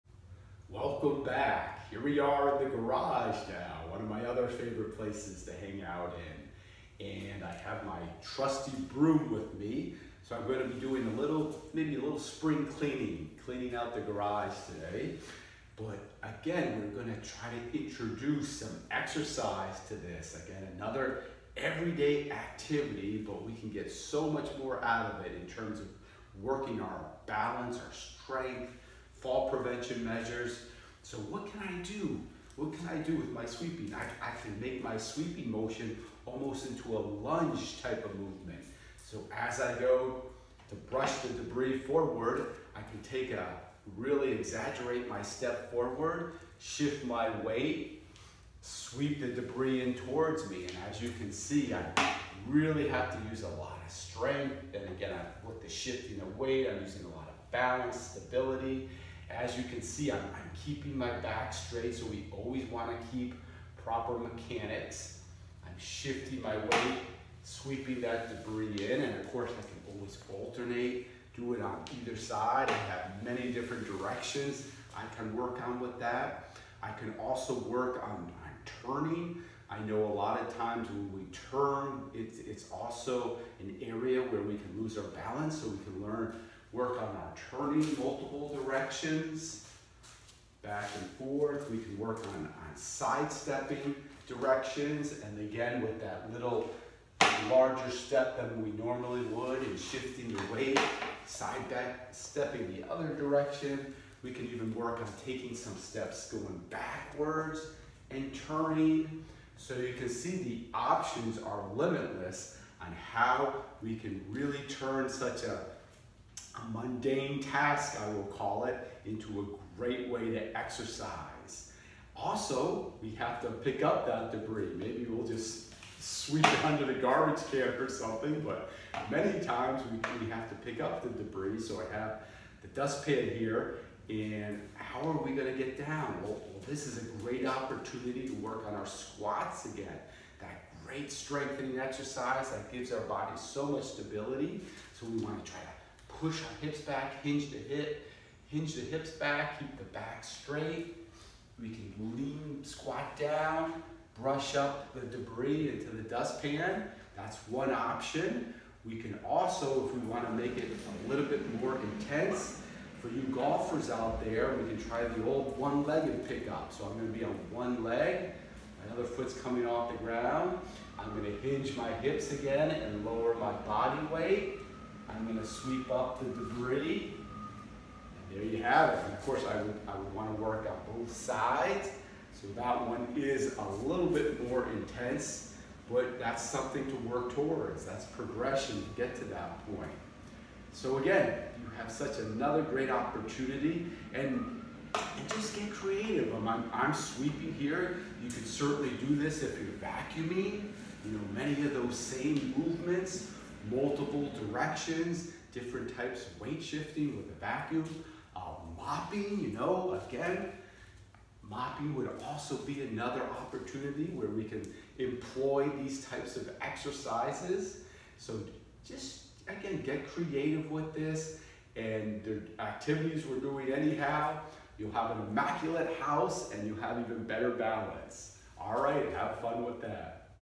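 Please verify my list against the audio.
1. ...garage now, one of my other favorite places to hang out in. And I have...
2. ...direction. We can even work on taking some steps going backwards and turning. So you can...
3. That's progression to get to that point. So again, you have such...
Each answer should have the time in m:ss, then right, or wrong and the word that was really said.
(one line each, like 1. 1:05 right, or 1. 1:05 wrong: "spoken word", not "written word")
1. 0:02 right
2. 1:43 right
3. 3:07 right.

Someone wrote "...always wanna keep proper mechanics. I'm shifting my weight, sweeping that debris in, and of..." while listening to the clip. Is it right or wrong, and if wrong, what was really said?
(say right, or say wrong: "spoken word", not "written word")
right.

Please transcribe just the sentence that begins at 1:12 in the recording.
I have many different directions I can work on with that.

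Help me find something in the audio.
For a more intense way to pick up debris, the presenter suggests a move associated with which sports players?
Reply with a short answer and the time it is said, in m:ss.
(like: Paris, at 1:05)
Golfers, at 2:43.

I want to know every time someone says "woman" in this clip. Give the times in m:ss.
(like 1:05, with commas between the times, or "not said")
not said.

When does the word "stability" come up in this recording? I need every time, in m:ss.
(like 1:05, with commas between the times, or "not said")
0:57, 2:23.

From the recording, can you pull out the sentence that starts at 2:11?
So I have the dustpan here, and how are we gonna get down?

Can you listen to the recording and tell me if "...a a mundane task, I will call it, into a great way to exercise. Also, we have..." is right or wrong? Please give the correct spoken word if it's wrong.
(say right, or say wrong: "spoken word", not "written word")
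right.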